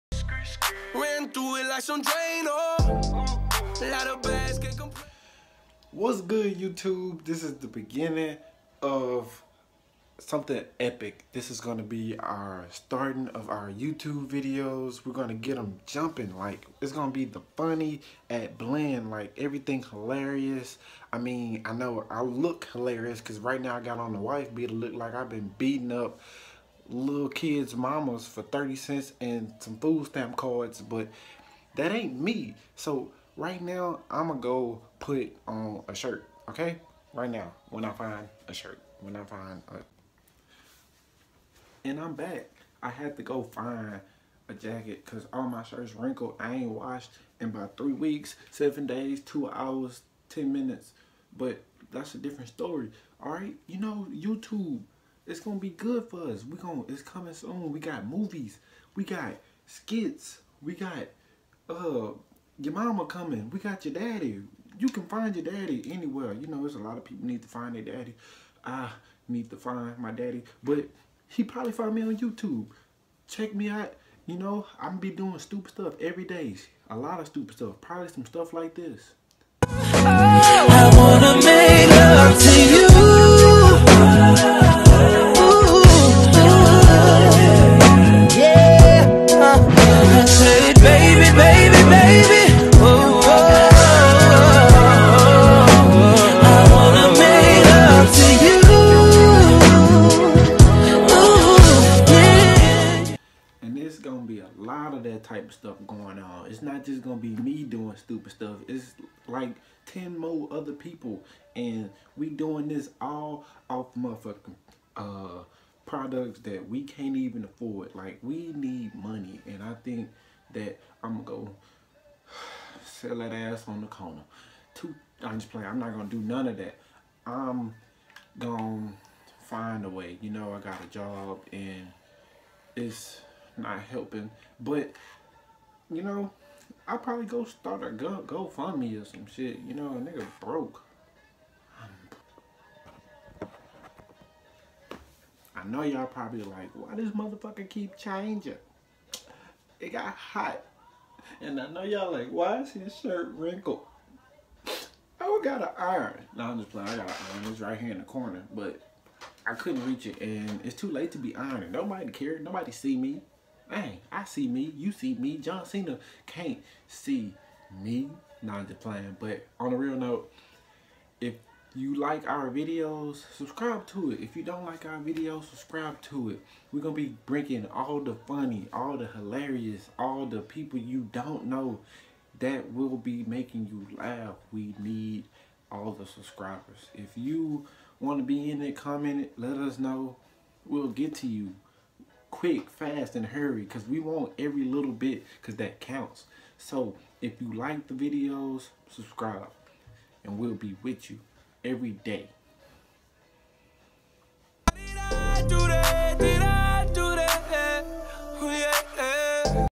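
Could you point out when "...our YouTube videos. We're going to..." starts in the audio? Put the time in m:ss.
0:13.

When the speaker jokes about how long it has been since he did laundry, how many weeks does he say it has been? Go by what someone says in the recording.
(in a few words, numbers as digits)
3 weeks.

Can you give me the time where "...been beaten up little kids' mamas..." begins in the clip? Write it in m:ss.
0:25.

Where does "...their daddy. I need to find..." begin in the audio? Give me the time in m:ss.
1:07.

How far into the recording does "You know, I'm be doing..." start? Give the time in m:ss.
1:14.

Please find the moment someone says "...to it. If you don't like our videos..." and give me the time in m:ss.
2:53.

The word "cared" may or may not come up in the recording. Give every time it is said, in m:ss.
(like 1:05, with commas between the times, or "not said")
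2:42.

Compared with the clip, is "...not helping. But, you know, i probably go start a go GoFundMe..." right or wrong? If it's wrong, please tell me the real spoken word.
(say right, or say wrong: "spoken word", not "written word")
right.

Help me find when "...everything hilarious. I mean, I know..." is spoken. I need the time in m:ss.
0:19.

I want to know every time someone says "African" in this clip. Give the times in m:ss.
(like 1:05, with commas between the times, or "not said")
not said.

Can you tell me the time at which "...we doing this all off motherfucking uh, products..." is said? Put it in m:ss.
1:52.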